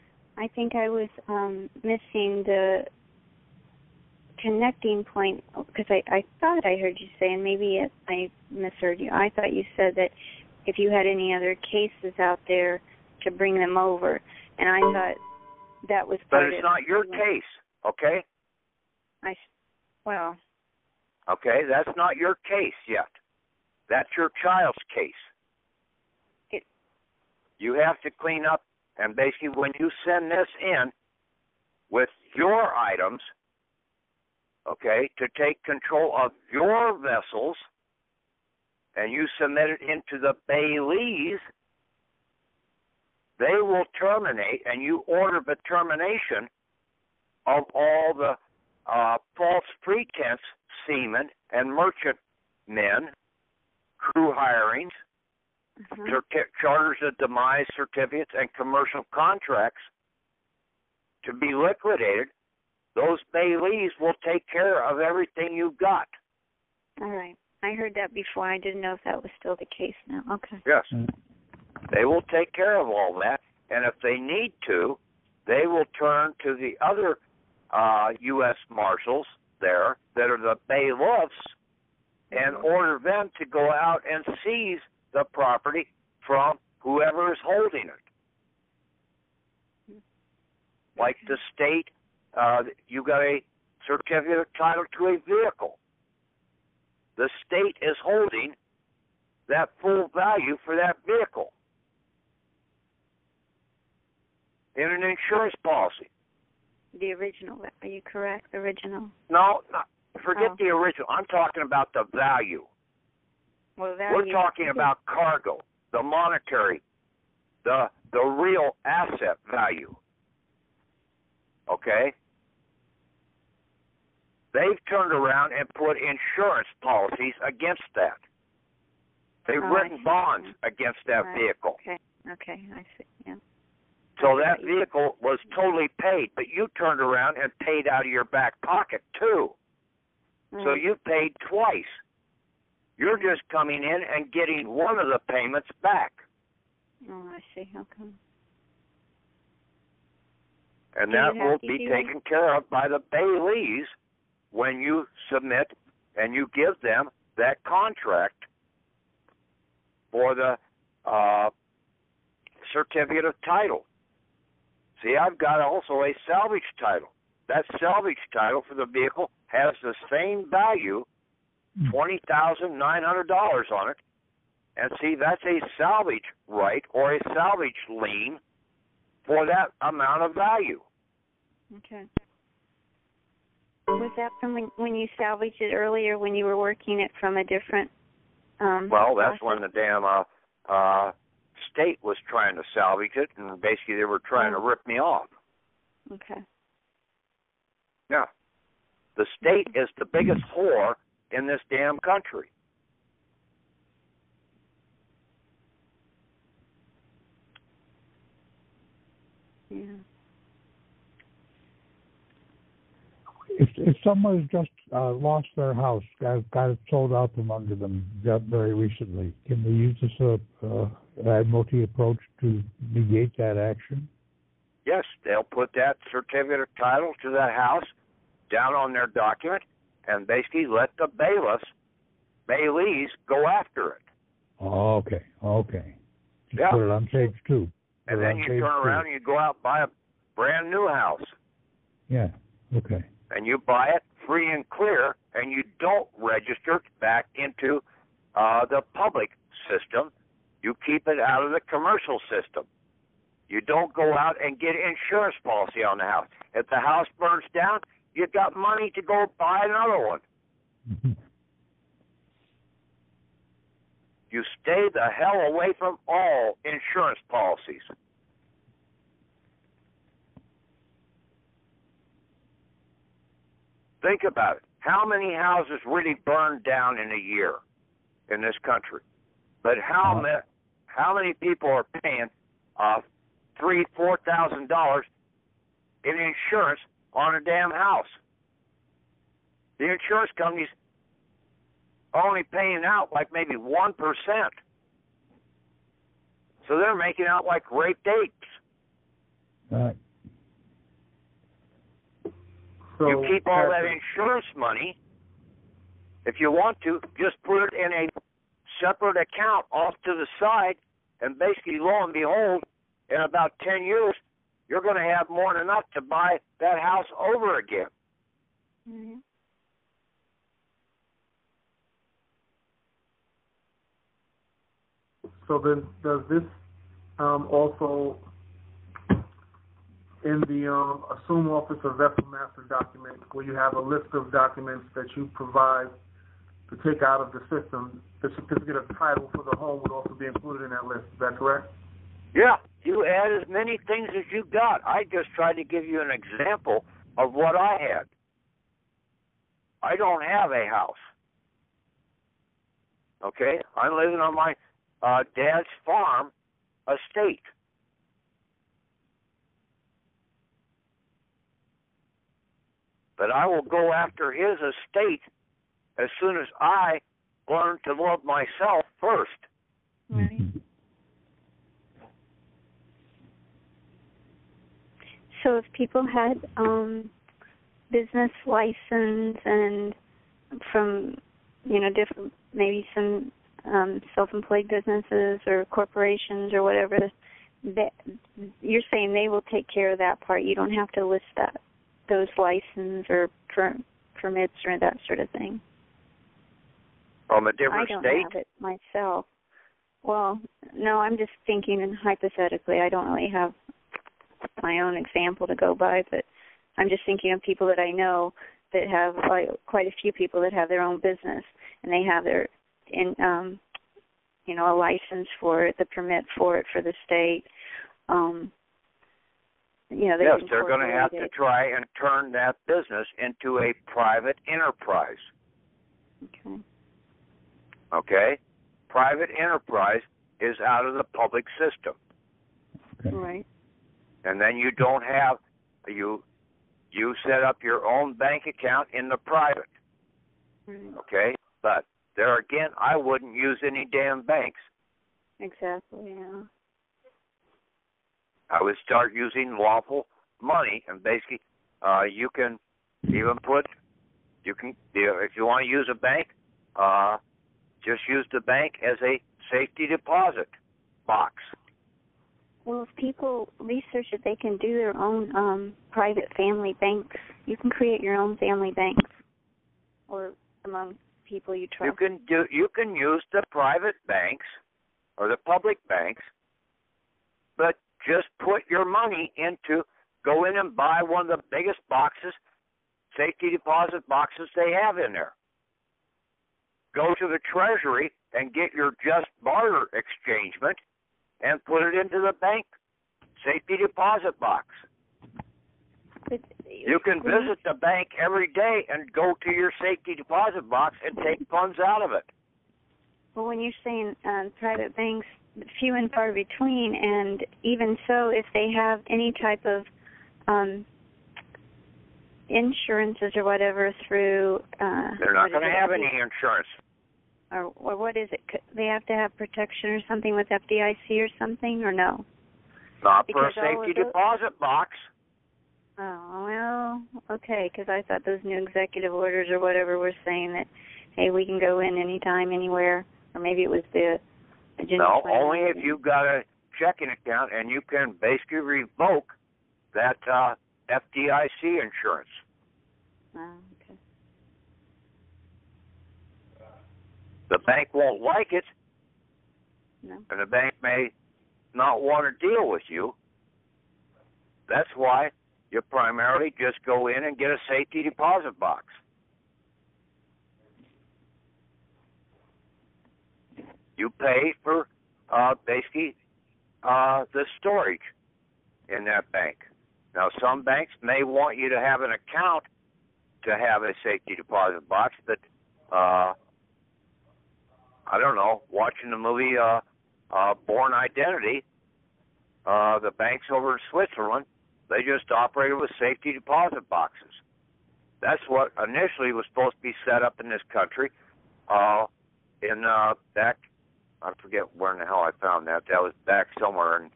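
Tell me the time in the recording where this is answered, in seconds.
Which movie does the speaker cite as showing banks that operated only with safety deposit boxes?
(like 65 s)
580 s.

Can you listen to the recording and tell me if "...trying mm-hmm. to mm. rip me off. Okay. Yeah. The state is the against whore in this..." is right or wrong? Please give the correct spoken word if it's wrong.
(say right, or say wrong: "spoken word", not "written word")
wrong: "biggest", not "against".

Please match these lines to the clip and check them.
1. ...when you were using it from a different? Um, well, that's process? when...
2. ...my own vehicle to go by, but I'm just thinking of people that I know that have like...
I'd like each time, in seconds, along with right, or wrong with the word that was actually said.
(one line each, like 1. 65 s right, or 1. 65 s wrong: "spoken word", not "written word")
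1. 186 s wrong: "working", not "using"
2. 404 s wrong: "example", not "vehicle".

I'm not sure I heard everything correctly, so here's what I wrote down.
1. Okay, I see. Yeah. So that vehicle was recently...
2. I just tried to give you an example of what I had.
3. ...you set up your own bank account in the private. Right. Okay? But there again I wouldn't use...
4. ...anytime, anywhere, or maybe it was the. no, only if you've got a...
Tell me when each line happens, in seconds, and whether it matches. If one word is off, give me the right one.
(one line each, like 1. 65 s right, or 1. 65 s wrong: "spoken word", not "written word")
1. 132 s wrong: "totally", not "recently"
2. 344 s right
3. 436 s right
4. 531 s right.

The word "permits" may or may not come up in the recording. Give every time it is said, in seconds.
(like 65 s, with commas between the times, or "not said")
394 s, 415 s.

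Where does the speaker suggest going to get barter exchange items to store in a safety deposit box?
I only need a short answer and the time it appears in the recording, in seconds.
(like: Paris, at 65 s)
The Treasury, at 487 s.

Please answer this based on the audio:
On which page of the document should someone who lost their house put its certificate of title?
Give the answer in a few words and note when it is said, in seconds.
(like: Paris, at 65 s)
Page two, at 237 s.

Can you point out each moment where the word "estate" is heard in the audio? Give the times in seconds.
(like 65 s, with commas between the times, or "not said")
356 s, 364 s.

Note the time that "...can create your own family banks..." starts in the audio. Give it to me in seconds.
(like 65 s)
467 s.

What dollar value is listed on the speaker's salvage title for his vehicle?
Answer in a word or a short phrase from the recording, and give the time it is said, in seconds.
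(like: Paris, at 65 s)
$20,900, at 171 s.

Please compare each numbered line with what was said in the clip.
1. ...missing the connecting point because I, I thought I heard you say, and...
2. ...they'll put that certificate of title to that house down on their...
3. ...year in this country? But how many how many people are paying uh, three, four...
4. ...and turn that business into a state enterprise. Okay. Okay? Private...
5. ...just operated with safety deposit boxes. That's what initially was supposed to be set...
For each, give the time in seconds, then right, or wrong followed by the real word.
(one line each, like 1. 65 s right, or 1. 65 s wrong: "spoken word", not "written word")
1. 1 s right
2. 225 s right
3. 277 s right
4. 421 s wrong: "private", not "state"
5. 585 s right.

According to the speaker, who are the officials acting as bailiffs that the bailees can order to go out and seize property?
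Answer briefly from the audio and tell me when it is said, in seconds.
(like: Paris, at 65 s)
U.S. Marshals, at 78 s.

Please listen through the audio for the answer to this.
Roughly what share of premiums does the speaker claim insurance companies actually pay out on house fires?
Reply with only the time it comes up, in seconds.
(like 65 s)
293 s.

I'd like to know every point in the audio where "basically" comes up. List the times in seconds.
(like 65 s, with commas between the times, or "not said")
29 s, 193 s, 230 s, 311 s, 451 s, 538 s, 565 s.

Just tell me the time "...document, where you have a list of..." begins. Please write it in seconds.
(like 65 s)
332 s.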